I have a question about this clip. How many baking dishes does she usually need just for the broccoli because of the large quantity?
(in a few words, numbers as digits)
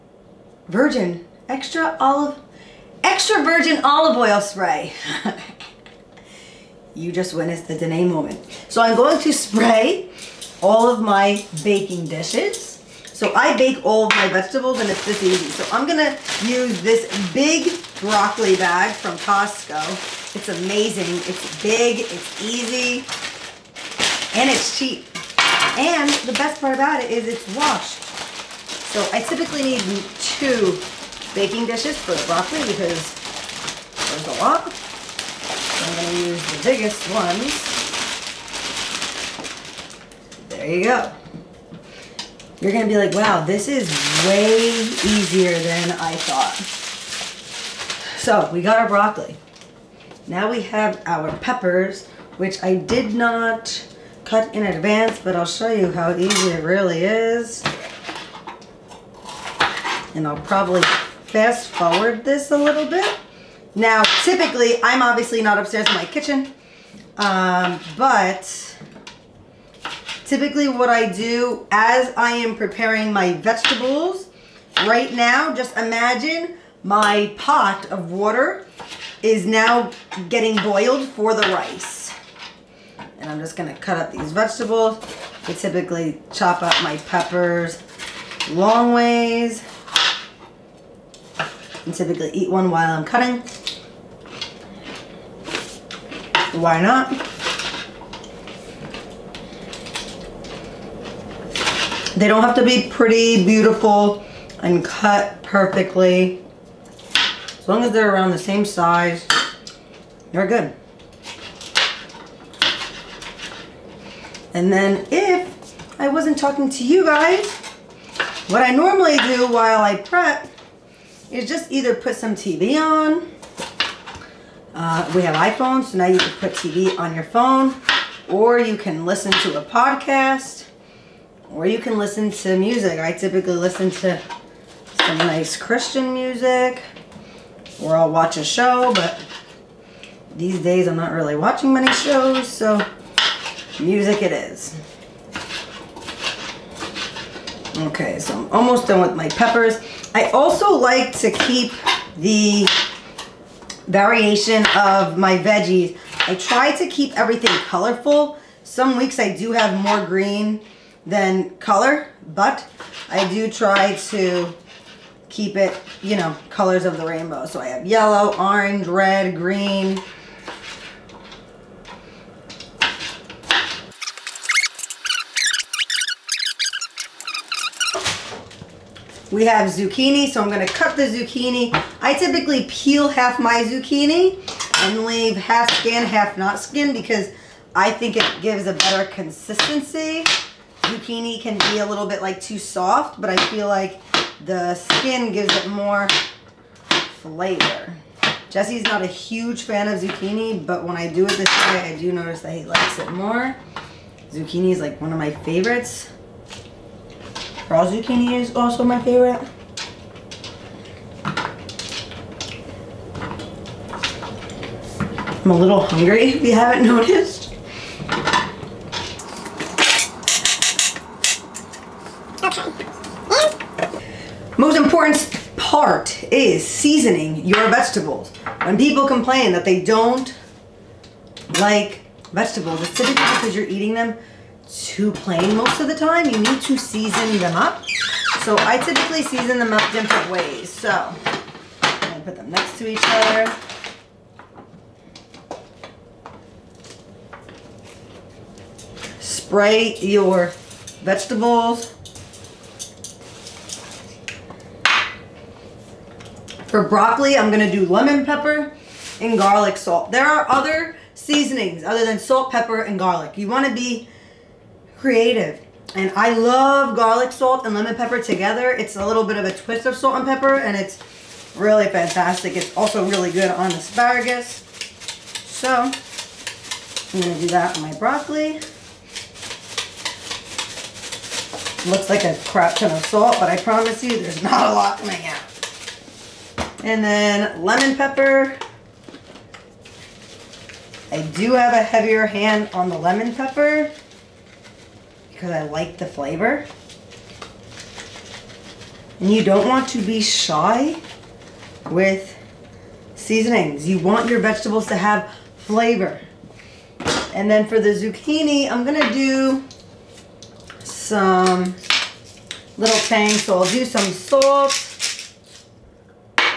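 2.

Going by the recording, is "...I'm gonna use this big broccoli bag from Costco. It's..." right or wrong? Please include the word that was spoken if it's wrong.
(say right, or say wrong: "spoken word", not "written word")
right.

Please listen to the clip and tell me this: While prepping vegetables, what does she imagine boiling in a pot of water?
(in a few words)
Rice.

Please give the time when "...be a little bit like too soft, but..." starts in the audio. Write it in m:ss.
3:11.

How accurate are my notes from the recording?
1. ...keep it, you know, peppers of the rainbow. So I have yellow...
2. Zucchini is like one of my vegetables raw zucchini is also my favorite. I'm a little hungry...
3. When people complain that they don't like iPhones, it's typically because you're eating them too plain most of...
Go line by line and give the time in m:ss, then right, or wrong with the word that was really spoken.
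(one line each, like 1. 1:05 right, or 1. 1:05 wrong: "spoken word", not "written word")
1. 2:45 wrong: "colors", not "peppers"
2. 3:24 wrong: "favorites", not "vegetables"
3. 3:48 wrong: "vegetables", not "iPhones".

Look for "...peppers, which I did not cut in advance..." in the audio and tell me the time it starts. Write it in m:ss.
0:51.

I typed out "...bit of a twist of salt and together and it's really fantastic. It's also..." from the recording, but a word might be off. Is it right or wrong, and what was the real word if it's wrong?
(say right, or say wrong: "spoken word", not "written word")
wrong: "pepper", not "together".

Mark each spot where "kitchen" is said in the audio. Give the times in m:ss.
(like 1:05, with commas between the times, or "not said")
1:06.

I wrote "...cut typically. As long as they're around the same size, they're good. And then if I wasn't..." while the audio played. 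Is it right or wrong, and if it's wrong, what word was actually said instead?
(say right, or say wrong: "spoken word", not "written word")
wrong: "perfectly", not "typically".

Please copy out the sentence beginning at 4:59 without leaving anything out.
And you don't want to be shy with seasonings.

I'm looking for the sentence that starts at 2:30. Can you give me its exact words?
I also like to keep the variation of my veggies.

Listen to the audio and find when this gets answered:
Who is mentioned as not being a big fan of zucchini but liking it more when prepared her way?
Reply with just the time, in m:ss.
3:18.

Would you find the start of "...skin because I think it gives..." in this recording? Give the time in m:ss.
3:06.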